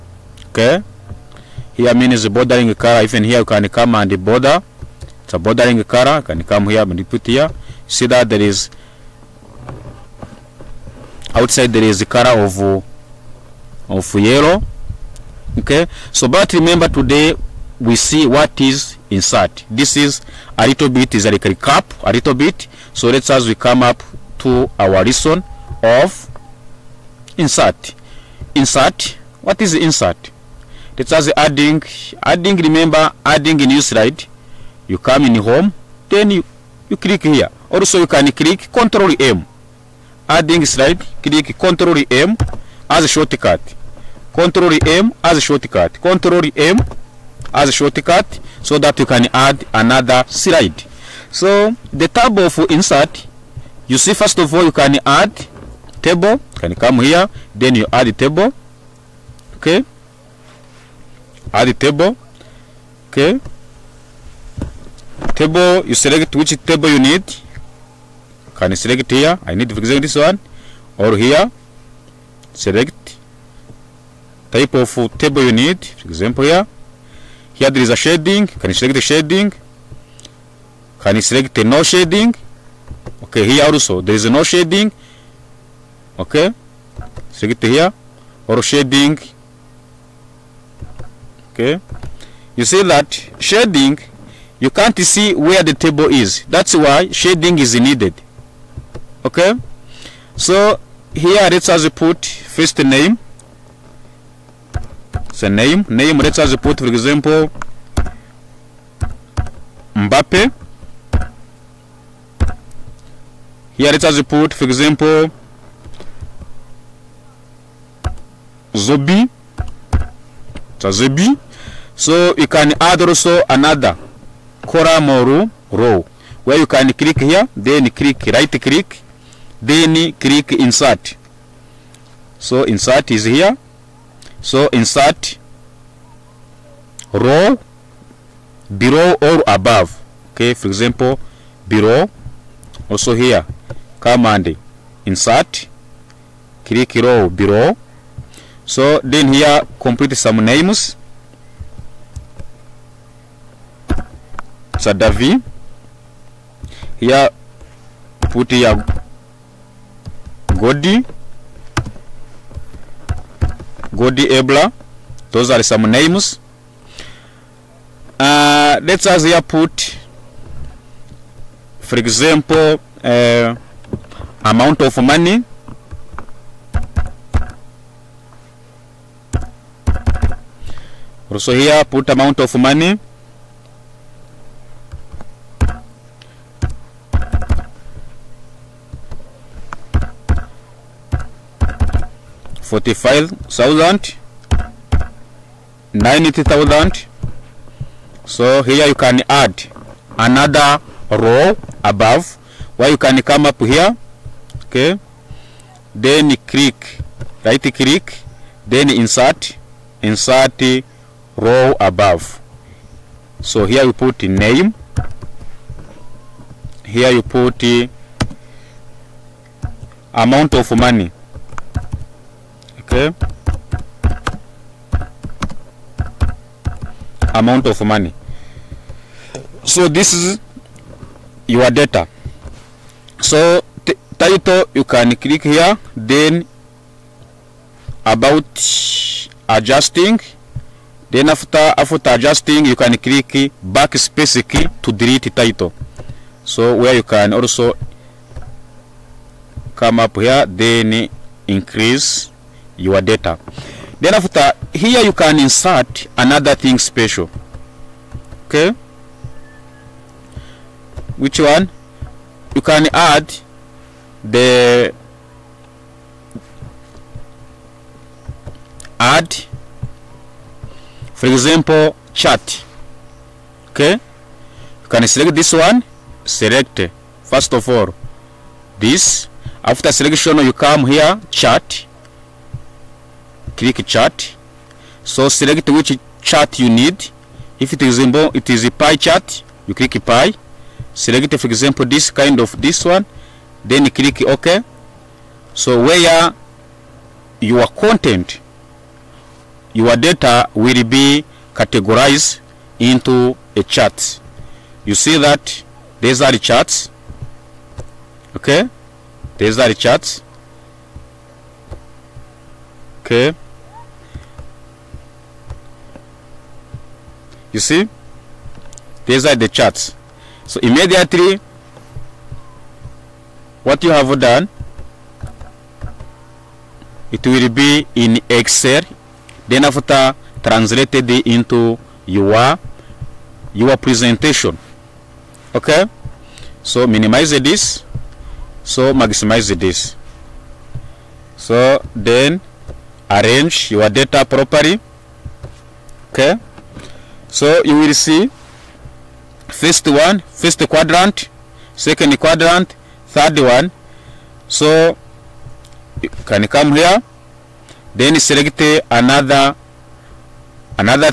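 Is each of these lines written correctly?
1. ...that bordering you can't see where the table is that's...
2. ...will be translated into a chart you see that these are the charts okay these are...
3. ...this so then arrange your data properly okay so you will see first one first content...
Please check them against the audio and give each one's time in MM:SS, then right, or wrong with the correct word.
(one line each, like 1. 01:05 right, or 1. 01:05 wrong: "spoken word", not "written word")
1. 01:32 wrong: "shading", not "bordering"
2. 05:00 wrong: "categorized", not "translated"
3. 05:39 wrong: "quadrant", not "content".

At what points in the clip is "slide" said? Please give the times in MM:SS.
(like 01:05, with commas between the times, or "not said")
00:33, 00:40, 00:50.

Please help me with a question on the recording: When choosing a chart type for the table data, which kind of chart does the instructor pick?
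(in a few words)
pie chart.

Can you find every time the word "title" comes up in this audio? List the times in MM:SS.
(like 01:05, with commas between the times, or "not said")
03:54, 04:05.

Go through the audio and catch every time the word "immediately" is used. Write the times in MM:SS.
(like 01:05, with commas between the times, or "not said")
05:20.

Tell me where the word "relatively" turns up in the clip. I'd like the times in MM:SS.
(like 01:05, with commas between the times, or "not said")
not said.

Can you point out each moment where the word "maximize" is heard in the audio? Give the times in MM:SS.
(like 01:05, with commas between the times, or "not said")
05:38.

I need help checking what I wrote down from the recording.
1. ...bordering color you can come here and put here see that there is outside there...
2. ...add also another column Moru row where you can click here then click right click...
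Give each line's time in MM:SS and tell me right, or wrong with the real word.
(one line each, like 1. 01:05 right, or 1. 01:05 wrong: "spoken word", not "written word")
1. 00:05 right
2. 02:02 right.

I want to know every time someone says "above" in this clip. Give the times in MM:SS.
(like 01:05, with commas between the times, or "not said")
02:19, 03:21, 03:31.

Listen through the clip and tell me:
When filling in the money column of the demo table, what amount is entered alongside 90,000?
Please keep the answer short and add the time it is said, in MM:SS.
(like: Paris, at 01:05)
45,000, at 03:12.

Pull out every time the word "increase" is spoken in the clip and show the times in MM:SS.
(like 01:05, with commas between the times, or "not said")
04:11.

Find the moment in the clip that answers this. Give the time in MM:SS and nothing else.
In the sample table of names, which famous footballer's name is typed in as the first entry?
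01:49.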